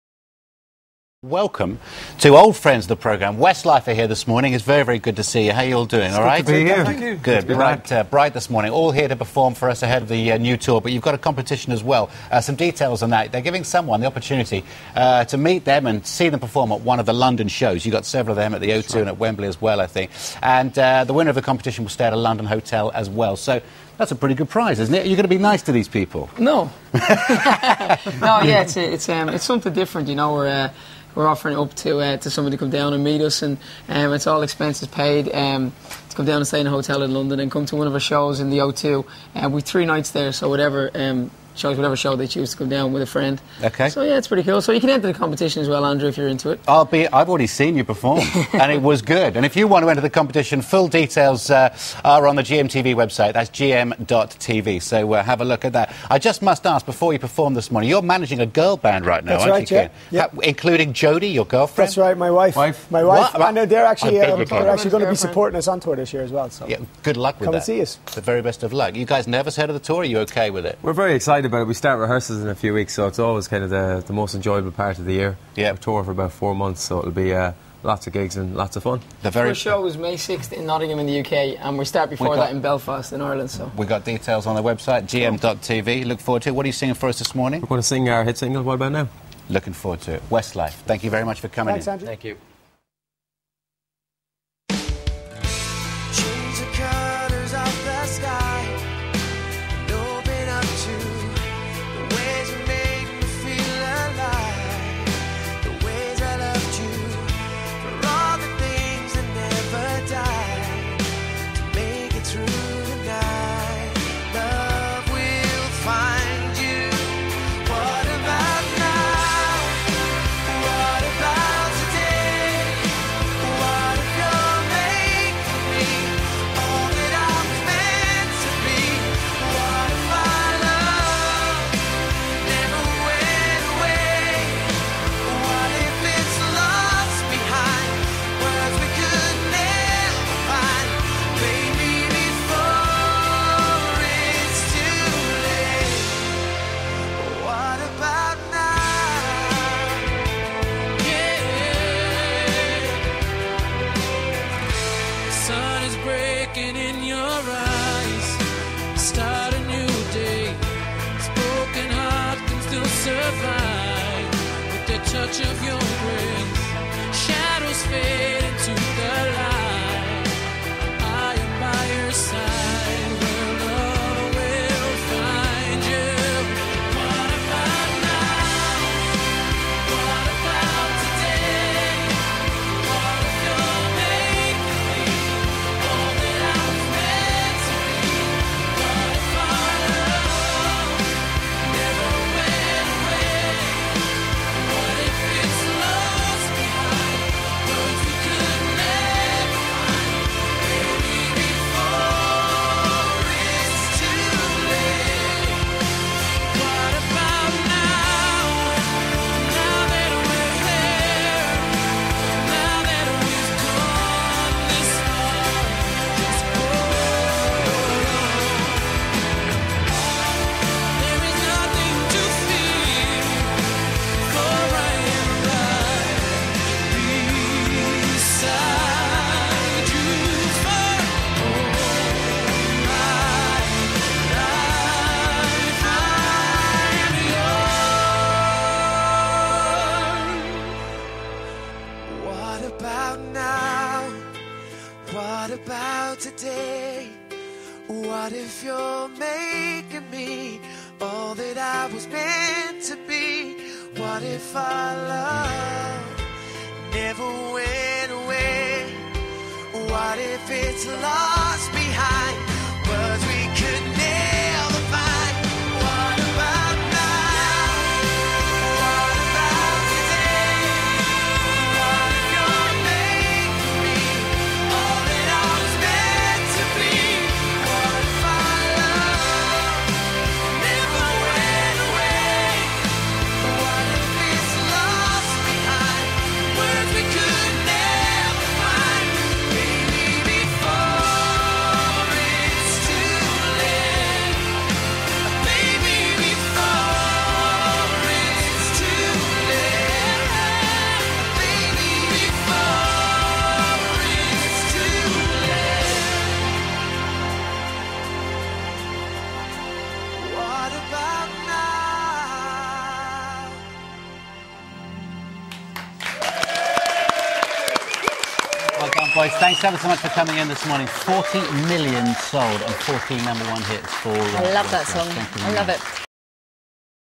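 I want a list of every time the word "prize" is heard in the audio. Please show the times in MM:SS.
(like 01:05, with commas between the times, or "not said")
00:24.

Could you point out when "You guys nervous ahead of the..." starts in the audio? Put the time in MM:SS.
01:08.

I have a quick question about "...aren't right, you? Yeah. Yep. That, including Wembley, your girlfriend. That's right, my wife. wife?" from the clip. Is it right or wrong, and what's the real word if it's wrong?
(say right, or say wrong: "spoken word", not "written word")
wrong: "Jody", not "Wembley".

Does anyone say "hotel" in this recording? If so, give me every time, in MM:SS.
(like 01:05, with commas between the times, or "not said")
00:22, 00:36.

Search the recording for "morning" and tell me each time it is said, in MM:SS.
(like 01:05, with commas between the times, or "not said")
00:04, 00:08, 00:57, 01:27, 05:20.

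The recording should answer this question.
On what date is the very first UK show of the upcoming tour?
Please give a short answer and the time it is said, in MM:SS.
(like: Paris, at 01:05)
May 6th, at 01:19.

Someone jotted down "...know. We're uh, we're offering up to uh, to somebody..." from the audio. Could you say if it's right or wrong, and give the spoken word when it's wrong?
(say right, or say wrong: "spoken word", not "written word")
right.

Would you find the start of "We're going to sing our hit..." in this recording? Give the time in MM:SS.
01:27.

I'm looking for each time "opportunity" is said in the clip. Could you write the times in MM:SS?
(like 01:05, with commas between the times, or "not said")
00:14.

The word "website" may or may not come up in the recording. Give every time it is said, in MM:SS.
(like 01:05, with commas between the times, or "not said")
00:52, 01:24.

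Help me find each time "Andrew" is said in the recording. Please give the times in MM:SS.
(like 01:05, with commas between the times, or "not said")
00:45, 01:31.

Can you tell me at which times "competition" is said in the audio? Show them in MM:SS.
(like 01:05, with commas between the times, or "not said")
00:11, 00:21, 00:45, 00:50.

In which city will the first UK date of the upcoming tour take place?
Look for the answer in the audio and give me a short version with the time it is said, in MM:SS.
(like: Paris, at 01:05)
Nottingham, at 01:20.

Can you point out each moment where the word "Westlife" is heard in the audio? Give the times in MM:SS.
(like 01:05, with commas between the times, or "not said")
00:03, 01:30.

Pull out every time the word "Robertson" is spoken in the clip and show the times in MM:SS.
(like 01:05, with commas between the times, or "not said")
not said.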